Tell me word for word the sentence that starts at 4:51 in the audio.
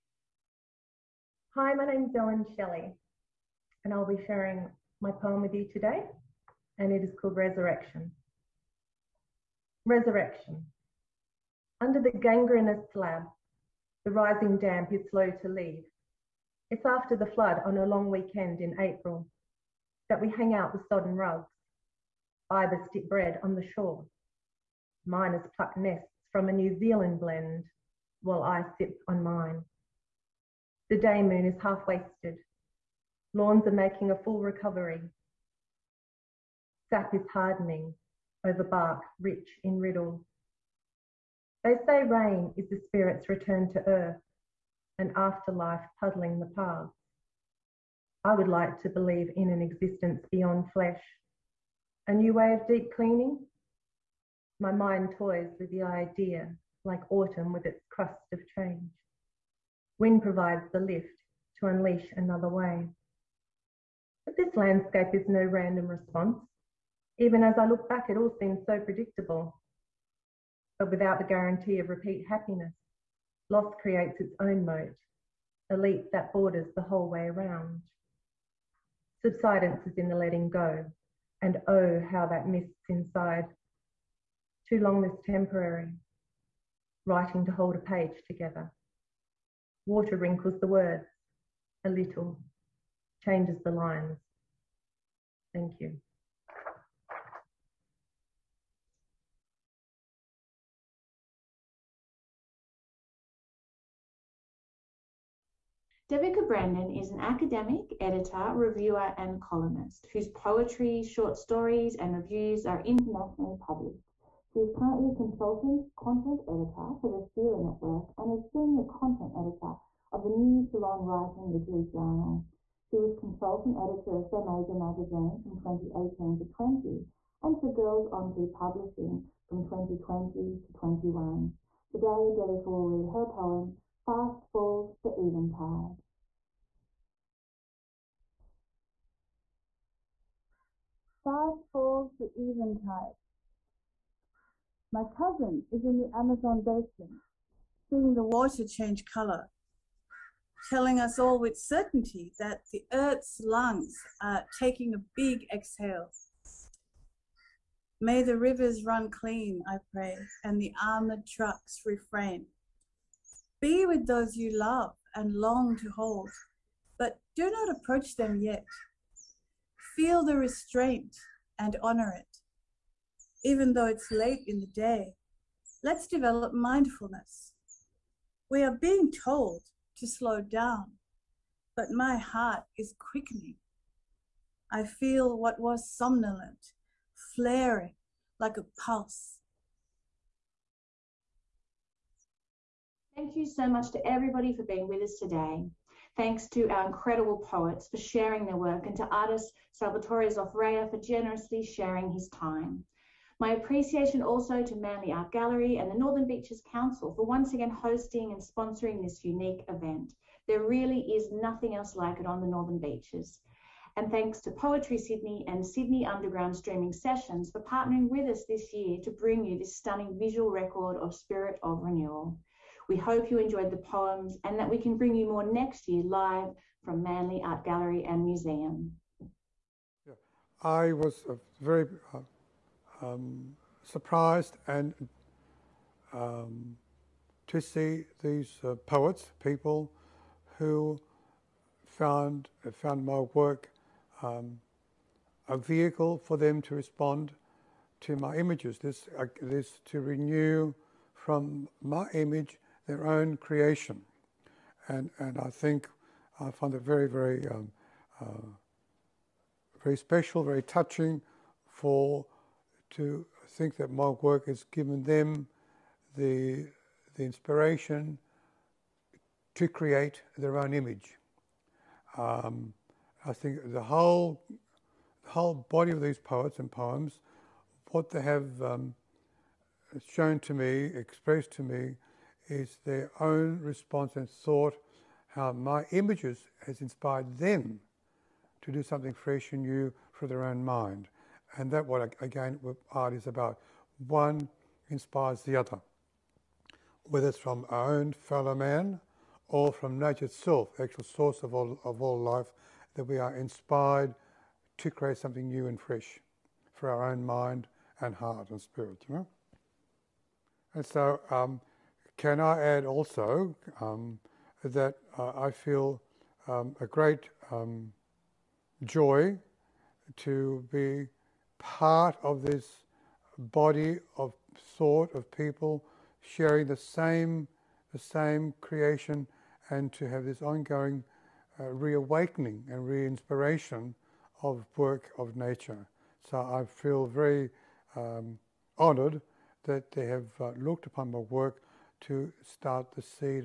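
And that what again what art is about.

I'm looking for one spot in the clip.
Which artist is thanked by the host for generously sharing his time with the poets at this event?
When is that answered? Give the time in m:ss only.
3:19.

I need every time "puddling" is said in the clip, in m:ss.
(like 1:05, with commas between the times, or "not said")
0:46.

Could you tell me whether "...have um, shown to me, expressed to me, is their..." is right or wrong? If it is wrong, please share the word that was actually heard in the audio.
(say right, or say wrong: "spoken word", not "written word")
right.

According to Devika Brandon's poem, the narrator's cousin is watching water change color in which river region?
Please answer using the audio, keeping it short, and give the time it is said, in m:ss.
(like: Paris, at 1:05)
Amazon basin, at 2:26.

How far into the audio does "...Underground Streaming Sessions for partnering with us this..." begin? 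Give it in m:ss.
3:36.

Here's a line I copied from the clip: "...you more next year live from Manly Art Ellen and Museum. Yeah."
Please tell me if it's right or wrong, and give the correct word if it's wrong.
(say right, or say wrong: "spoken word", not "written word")
wrong: "Gallery", not "Ellen".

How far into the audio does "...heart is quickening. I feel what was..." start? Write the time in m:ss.
3:02.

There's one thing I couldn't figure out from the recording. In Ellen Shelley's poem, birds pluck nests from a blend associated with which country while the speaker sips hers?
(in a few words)
New Zealand.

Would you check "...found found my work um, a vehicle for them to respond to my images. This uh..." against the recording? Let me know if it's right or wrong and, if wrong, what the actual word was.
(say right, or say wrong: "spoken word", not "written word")
right.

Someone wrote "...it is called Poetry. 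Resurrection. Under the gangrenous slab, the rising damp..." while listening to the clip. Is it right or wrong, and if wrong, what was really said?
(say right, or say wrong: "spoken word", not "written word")
wrong: "Resurrection", not "Poetry".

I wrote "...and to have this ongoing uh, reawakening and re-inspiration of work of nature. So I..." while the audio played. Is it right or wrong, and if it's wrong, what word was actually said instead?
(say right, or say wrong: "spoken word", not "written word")
right.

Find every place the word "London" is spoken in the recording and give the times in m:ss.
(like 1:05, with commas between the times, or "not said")
not said.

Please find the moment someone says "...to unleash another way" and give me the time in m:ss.
1:01.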